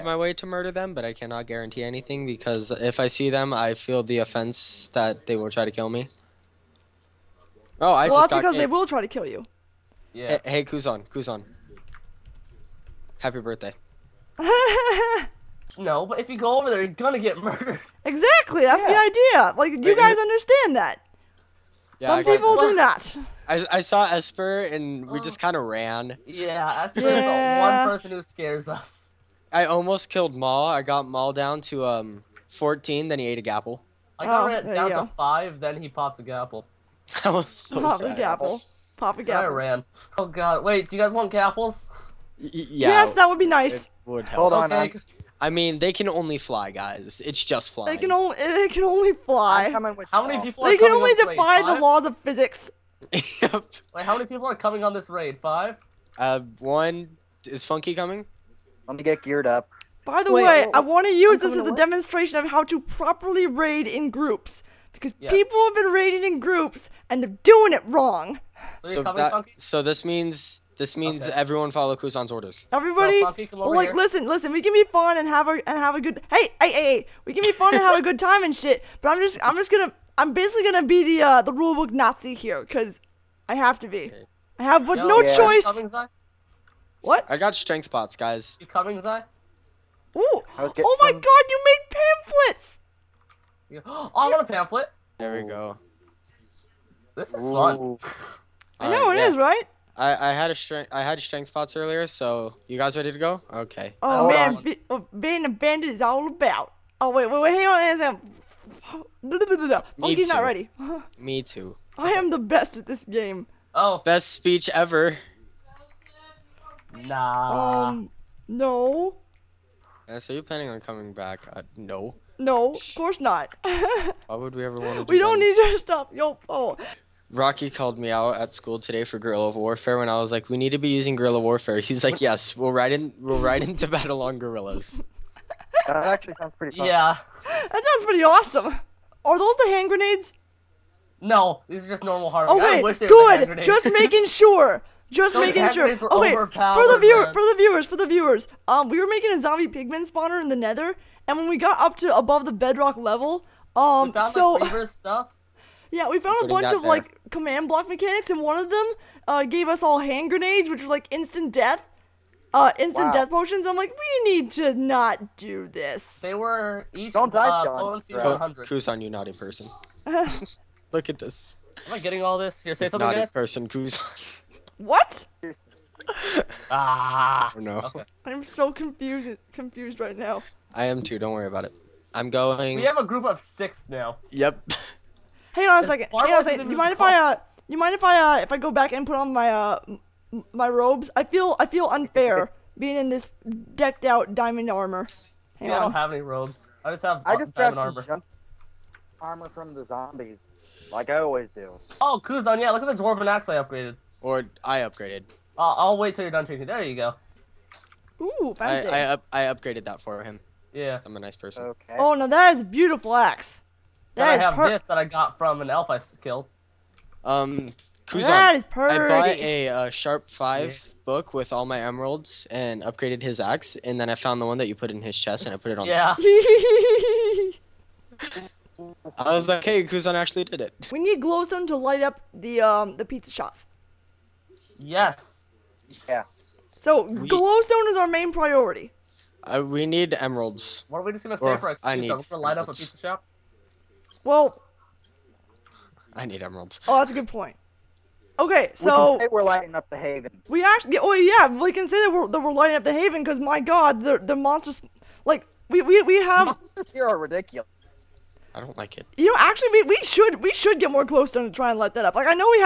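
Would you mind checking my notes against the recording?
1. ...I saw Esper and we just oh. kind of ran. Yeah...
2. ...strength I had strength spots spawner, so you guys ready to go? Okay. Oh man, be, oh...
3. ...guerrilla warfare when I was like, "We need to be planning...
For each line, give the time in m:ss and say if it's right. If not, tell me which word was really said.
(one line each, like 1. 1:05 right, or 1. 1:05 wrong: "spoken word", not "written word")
1. 0:23 right
2. 1:40 wrong: "earlier", not "spawner"
3. 2:09 wrong: "using", not "planning".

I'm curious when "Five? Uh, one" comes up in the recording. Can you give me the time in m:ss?
0:55.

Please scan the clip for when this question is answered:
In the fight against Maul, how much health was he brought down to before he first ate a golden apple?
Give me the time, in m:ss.
0:32.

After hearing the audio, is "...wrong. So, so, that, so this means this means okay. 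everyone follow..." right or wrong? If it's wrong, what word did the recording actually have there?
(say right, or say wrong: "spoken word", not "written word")
right.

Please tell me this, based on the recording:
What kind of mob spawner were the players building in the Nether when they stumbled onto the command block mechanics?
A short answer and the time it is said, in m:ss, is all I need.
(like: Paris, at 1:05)
zombie pigman spawner, at 2:29.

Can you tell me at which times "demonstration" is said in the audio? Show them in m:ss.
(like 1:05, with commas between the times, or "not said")
1:01.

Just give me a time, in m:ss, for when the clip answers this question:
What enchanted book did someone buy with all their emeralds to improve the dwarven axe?
3:39.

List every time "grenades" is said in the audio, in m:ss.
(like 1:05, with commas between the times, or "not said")
2:19, 2:40.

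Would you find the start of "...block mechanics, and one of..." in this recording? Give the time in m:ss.
2:37.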